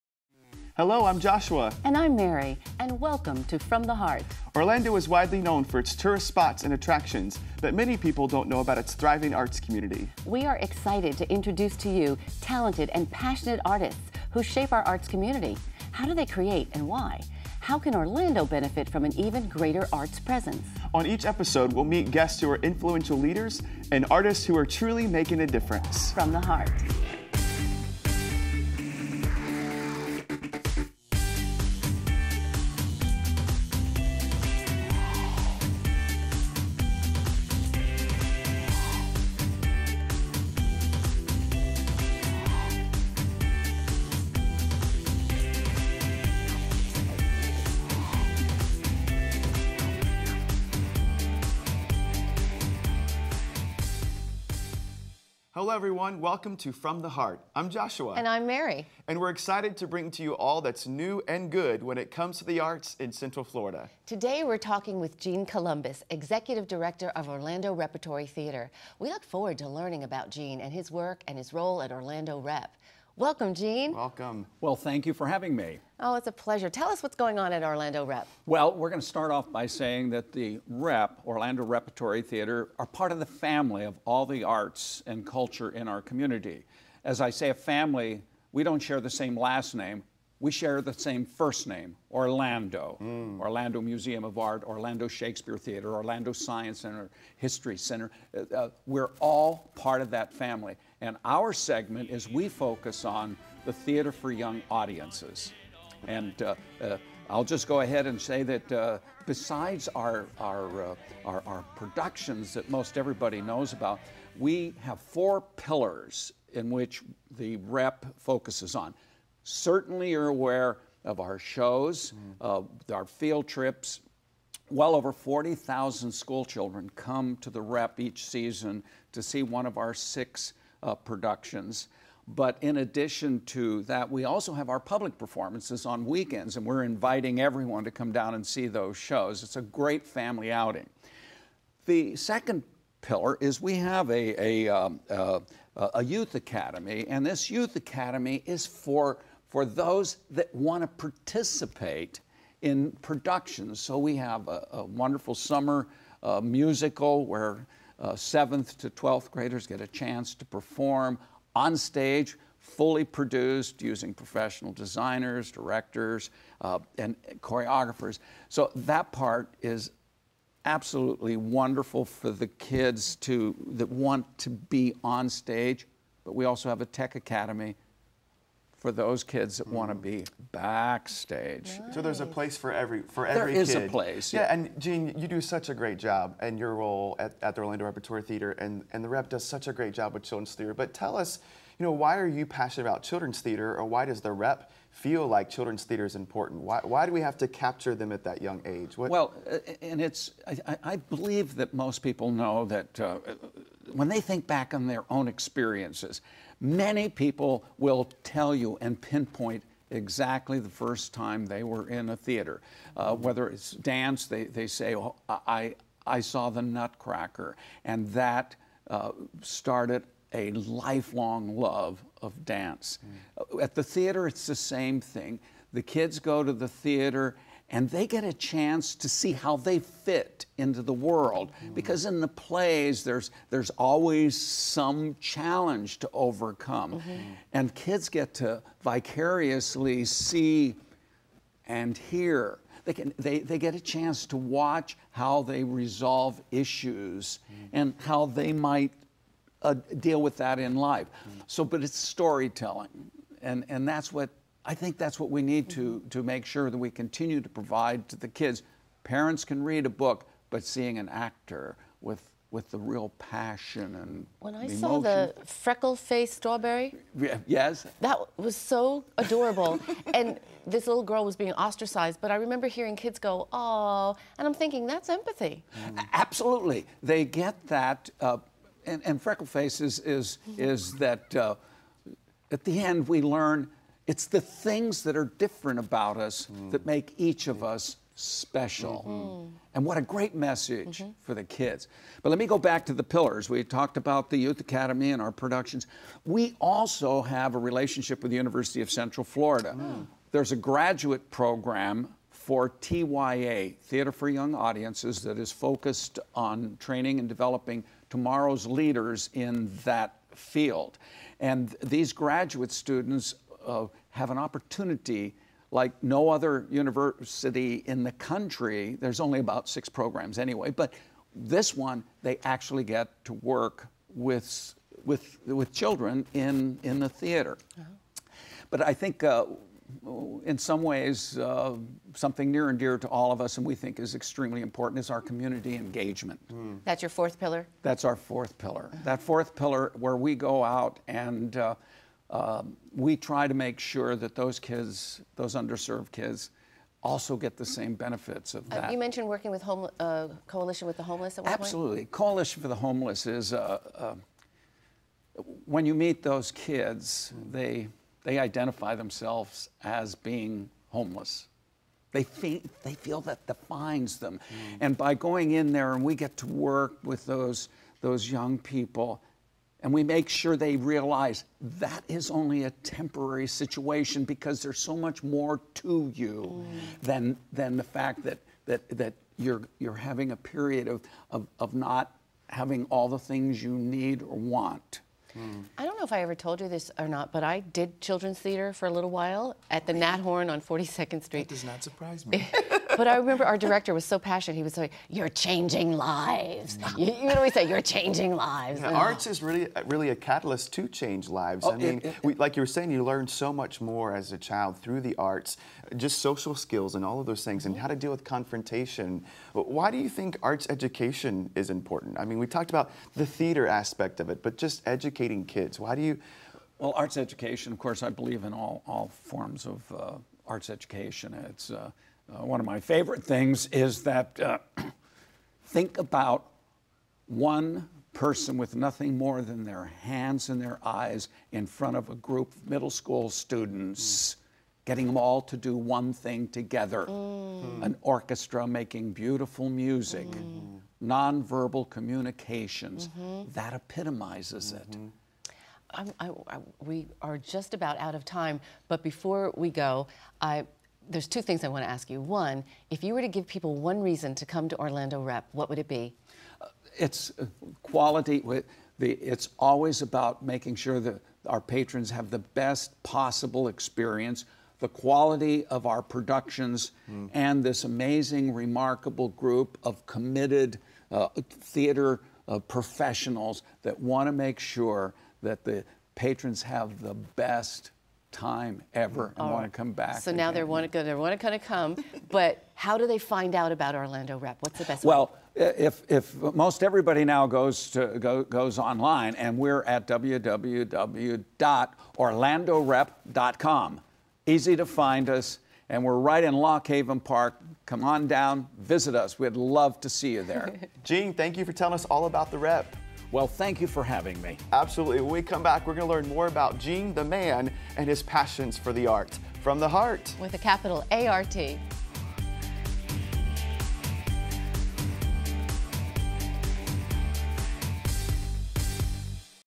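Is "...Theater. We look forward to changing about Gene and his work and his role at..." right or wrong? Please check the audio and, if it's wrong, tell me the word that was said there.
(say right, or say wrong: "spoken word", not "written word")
wrong: "learning", not "changing".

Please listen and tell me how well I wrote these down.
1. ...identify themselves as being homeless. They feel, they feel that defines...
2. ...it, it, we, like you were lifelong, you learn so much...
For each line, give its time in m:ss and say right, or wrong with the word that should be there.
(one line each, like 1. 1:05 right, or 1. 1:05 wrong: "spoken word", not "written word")
1. 5:58 right
2. 6:41 wrong: "saying", not "lifelong".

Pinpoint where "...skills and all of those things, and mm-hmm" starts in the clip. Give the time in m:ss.
6:46.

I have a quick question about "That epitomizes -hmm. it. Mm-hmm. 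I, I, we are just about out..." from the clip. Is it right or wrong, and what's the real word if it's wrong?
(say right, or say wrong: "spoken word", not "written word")
right.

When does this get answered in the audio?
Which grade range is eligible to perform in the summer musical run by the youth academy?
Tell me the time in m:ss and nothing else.
2:38.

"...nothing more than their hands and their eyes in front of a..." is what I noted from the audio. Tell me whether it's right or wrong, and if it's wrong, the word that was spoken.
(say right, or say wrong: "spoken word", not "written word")
right.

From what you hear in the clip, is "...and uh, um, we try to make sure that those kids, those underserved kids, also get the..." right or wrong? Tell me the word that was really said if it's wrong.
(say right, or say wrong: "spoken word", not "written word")
right.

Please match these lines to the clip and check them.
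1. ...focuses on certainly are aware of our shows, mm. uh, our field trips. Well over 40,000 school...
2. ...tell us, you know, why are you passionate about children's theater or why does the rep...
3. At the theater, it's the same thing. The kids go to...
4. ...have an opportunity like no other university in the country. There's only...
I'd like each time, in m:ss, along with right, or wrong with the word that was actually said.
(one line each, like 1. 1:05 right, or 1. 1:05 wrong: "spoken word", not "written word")
1. 1:58 right
2. 3:10 right
3. 3:43 right
4. 5:14 right.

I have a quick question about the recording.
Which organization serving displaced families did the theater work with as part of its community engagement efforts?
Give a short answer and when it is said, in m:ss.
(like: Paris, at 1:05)
Coalition for the Homeless, at 5:52.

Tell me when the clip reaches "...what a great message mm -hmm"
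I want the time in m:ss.
4:49.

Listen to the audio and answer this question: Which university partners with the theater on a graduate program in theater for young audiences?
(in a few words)
University of Central Florida.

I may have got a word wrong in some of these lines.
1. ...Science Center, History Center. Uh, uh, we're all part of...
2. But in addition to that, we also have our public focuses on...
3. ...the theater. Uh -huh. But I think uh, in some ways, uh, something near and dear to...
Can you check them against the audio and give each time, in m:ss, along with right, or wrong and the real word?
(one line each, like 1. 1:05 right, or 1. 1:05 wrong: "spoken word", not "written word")
1. 1:36 right
2. 2:12 wrong: "performances", not "focuses"
3. 5:26 right.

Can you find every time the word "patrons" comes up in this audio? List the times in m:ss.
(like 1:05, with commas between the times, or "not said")
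7:41, 7:56.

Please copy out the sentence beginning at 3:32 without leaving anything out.
Uh, whether it's dance, they, they say, oh, I, I saw the Nutcracker.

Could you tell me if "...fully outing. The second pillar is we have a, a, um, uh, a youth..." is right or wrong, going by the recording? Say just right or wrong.
wrong.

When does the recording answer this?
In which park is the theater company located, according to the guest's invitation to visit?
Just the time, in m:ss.
8:16.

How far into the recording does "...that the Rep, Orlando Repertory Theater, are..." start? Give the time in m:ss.
1:20.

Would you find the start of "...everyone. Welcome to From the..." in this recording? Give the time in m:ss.
0:55.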